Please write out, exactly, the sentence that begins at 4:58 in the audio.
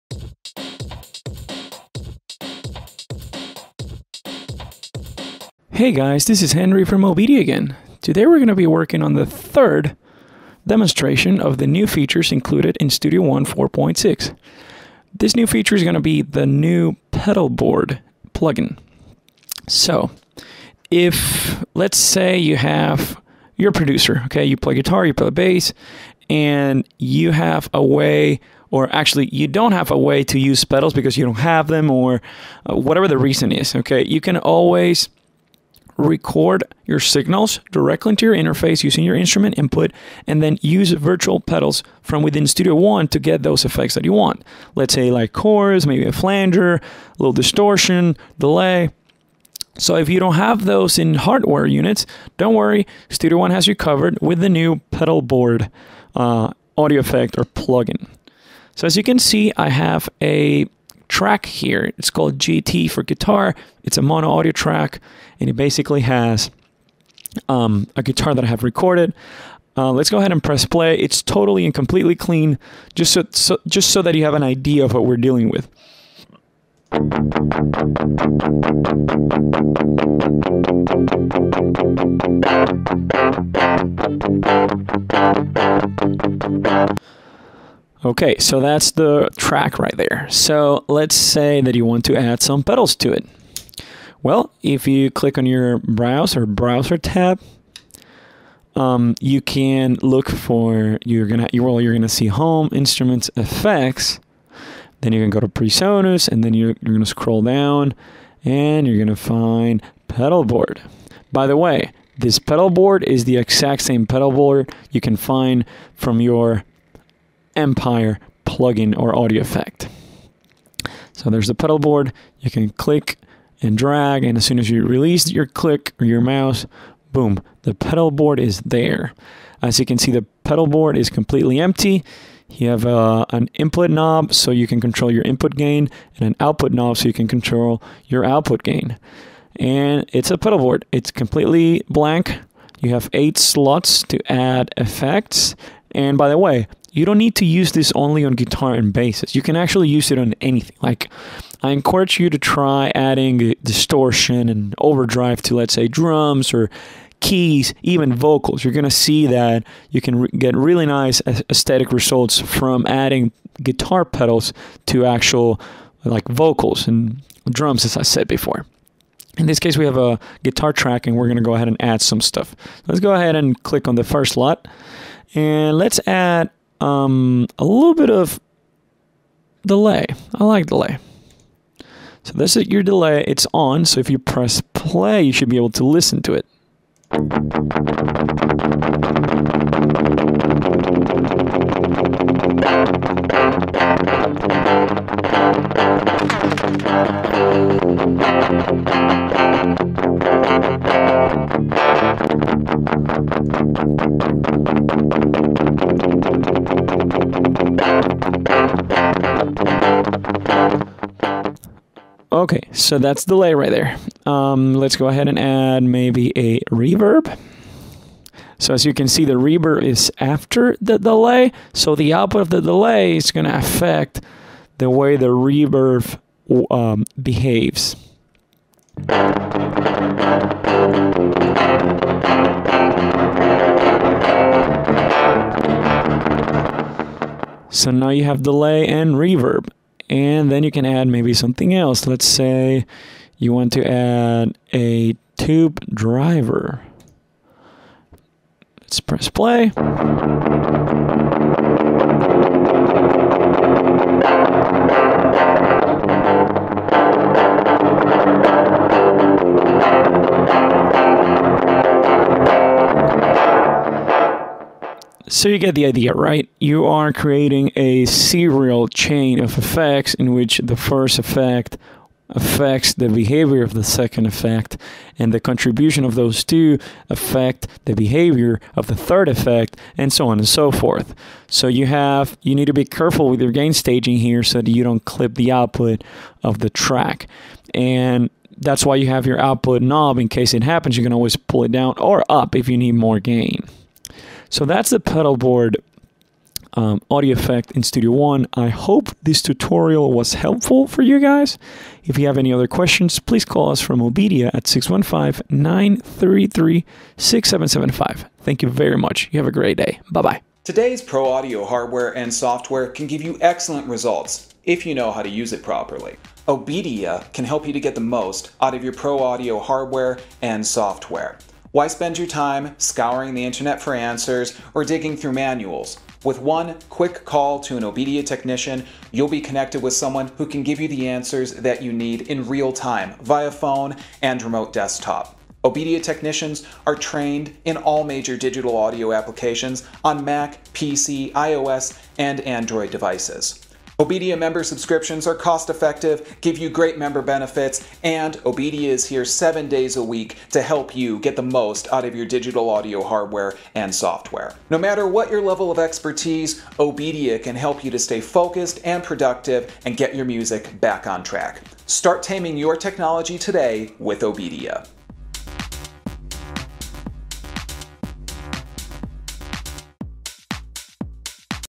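I hope this tutorial was helpful for you guys.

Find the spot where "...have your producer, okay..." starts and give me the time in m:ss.
0:22.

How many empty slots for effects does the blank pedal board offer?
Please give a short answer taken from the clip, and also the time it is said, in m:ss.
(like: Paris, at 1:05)
8, at 2:23.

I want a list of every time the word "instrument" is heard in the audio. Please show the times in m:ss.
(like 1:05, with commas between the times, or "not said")
0:39, 1:42.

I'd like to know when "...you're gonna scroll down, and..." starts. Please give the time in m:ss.
1:46.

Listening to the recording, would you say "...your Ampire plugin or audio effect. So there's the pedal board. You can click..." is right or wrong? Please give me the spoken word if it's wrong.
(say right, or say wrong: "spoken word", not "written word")
right.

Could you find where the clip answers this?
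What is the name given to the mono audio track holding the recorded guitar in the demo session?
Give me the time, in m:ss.
1:02.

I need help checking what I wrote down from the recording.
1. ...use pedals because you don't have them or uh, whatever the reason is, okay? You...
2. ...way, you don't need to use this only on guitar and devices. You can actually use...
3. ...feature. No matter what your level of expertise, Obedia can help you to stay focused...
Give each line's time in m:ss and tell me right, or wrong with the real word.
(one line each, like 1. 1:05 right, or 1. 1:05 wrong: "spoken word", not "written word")
1. 0:30 right
2. 2:26 wrong: "basses", not "devices"
3. 5:53 wrong: "software", not "feature".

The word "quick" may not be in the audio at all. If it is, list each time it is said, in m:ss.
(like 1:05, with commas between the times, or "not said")
5:26.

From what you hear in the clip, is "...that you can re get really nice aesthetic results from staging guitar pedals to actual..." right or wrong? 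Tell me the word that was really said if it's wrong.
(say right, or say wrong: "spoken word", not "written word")
wrong: "adding", not "staging".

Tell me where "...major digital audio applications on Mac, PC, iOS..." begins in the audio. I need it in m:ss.
5:38.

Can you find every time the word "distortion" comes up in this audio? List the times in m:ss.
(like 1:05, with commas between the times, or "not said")
0:47, 2:33.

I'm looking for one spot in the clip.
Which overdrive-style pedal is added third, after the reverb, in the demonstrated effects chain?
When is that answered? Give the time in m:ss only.
4:05.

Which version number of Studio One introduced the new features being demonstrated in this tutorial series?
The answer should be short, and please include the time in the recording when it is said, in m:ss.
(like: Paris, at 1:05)
4.6, at 0:12.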